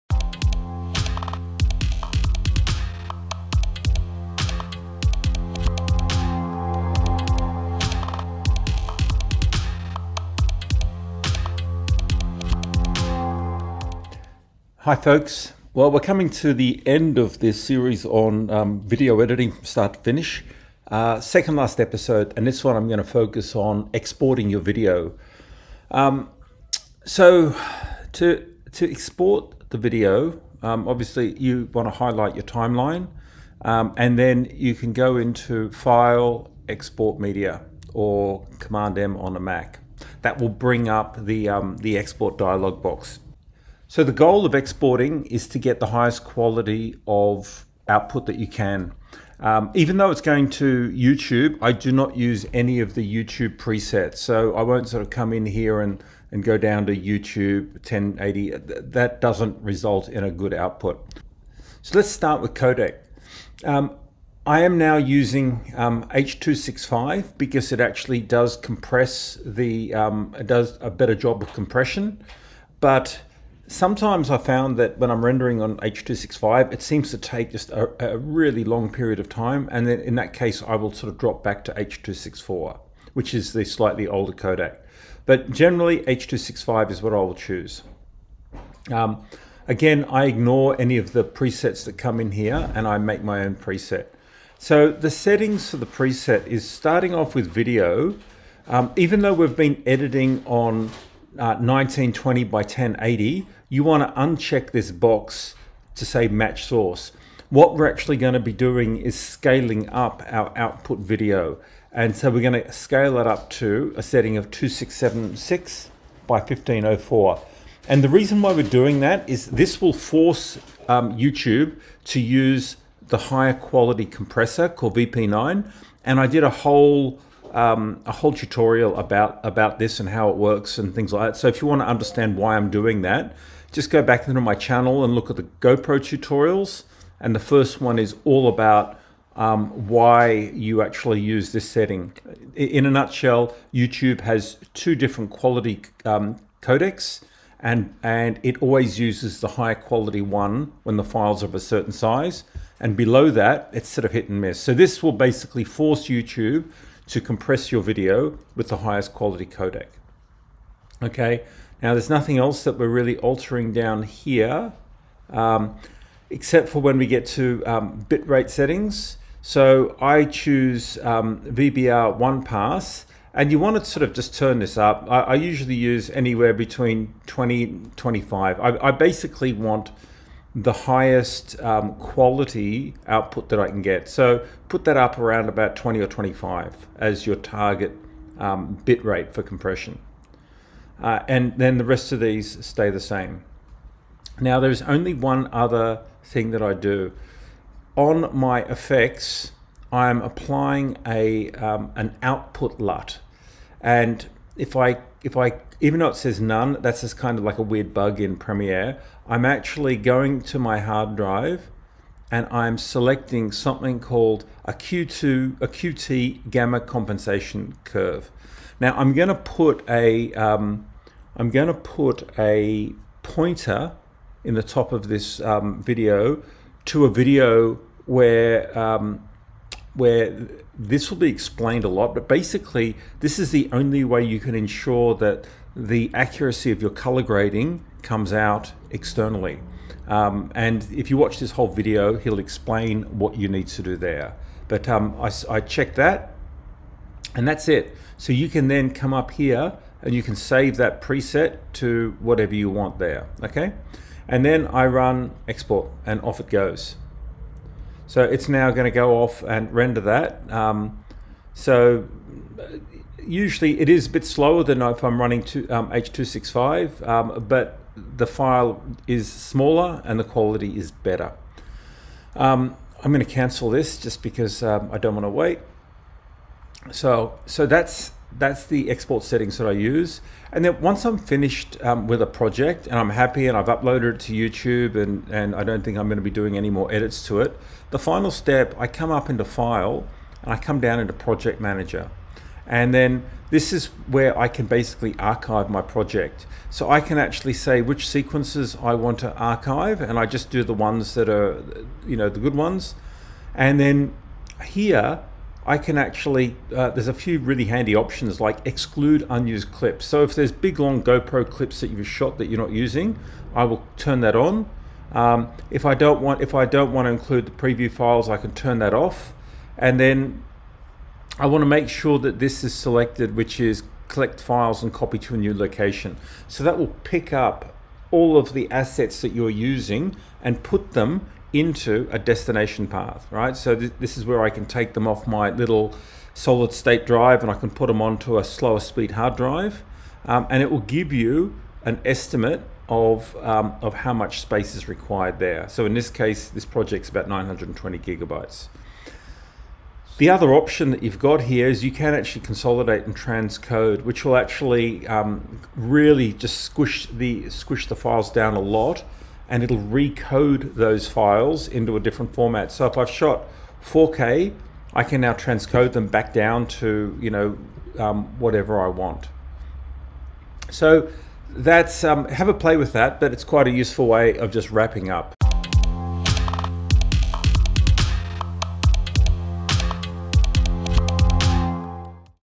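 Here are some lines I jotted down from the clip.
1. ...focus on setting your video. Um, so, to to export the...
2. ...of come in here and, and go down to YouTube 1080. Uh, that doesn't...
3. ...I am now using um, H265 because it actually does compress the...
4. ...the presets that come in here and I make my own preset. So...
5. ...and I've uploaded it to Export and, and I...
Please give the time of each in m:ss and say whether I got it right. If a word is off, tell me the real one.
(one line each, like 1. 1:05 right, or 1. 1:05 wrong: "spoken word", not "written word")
1. 0:23 wrong: "exporting", not "setting"
2. 0:55 right
3. 1:04 right
4. 1:31 right
5. 4:43 wrong: "YouTube", not "Export".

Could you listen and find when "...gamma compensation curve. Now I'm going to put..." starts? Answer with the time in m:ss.
3:36.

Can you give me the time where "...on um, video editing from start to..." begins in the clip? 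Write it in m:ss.
0:18.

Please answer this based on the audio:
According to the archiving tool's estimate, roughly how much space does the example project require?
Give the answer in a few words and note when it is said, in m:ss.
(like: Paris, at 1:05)
920 gigabytes, at 5:47.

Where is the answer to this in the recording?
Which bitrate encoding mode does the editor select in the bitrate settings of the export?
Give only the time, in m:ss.
2:51.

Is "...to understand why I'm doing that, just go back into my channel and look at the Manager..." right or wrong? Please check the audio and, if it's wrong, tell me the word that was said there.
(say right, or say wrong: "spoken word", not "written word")
wrong: "GoPro", not "Manager".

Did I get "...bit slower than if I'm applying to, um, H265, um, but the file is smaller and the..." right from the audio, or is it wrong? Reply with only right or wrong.
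wrong.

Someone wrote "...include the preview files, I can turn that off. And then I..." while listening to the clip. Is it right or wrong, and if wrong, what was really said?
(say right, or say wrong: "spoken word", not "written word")
right.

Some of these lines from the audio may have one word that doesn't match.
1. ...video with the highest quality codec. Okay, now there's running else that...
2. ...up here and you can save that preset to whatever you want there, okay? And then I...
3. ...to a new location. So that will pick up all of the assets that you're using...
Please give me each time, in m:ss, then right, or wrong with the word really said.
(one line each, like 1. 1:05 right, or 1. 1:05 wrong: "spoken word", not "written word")
1. 2:37 wrong: "nothing", not "running"
2. 4:09 right
3. 5:25 right.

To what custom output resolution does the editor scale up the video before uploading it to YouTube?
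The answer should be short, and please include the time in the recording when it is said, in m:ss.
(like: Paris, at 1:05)
2676 by 1504, at 1:54.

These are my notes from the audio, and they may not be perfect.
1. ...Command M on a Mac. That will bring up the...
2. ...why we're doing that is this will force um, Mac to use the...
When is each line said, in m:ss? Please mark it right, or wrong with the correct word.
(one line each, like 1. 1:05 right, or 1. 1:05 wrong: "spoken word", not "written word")
1. 0:38 right
2. 1:58 wrong: "YouTube", not "Mac".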